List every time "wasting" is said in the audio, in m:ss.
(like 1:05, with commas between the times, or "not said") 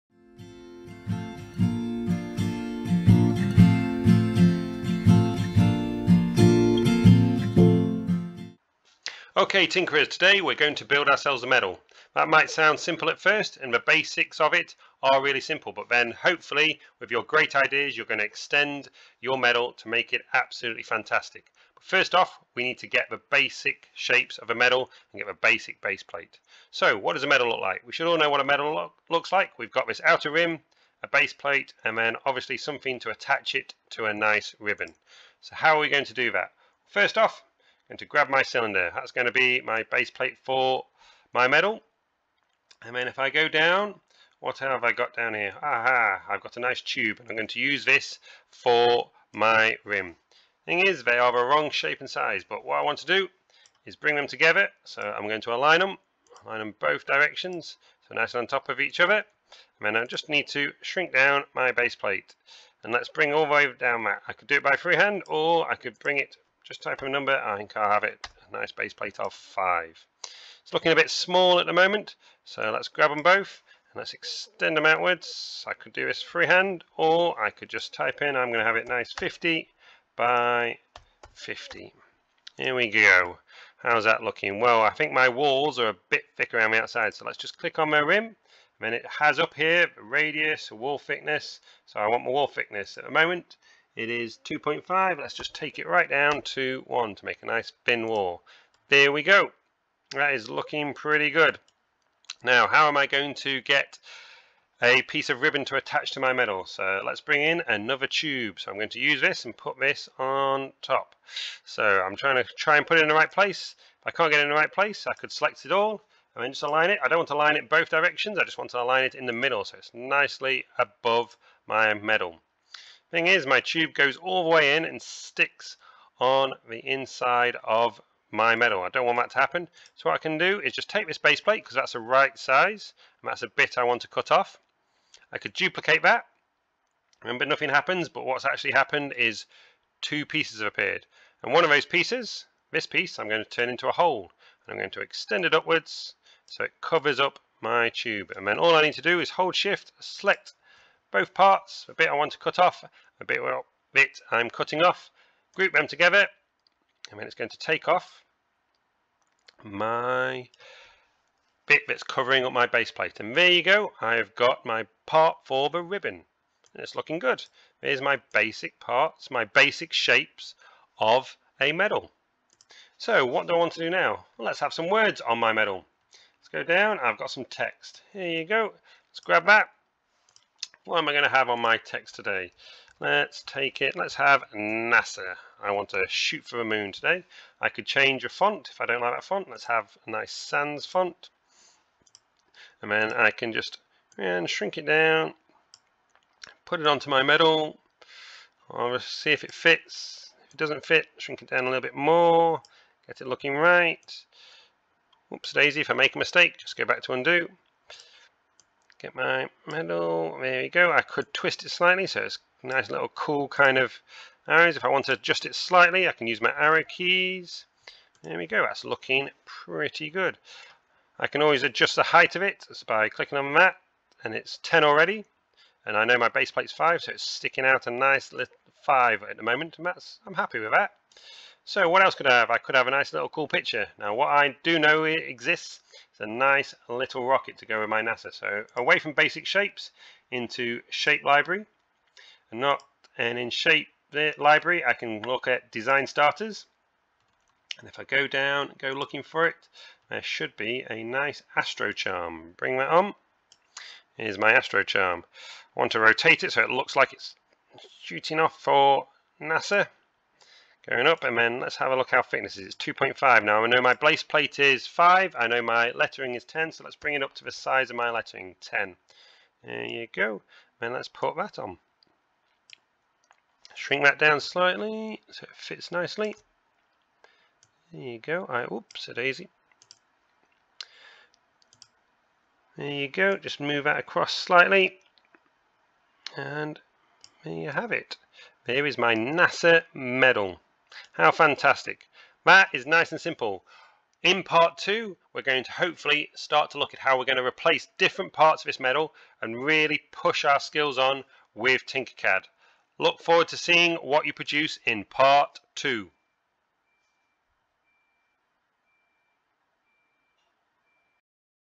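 not said.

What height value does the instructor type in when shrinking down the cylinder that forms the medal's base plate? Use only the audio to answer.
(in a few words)
5.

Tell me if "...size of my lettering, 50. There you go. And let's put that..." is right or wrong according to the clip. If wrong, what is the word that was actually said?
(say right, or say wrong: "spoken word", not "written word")
wrong: "10", not "50".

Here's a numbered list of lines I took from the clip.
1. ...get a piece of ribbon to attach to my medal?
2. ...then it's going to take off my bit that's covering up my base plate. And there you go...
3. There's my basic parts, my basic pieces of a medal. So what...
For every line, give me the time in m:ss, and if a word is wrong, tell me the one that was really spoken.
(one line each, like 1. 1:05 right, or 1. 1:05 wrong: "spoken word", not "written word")
1. 1:43 right
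2. 2:37 right
3. 2:47 wrong: "shapes", not "pieces".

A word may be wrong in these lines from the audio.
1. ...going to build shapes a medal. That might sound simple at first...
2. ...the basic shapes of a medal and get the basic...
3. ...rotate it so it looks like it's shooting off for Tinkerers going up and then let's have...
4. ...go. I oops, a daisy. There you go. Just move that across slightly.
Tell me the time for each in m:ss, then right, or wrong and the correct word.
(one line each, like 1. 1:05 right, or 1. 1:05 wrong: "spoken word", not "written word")
1. 0:10 wrong: "ourselves", not "shapes"
2. 0:23 right
3. 4:16 wrong: "NASA", not "Tinkerers"
4. 4:38 right.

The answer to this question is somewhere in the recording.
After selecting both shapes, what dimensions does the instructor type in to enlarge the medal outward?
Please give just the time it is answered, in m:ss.
1:19.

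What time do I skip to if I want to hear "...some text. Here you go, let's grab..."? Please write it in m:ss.
2:57.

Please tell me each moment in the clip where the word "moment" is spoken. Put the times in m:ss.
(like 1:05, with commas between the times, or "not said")
1:11, 1:33, 3:49.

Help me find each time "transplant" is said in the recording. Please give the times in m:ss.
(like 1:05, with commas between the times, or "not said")
not said.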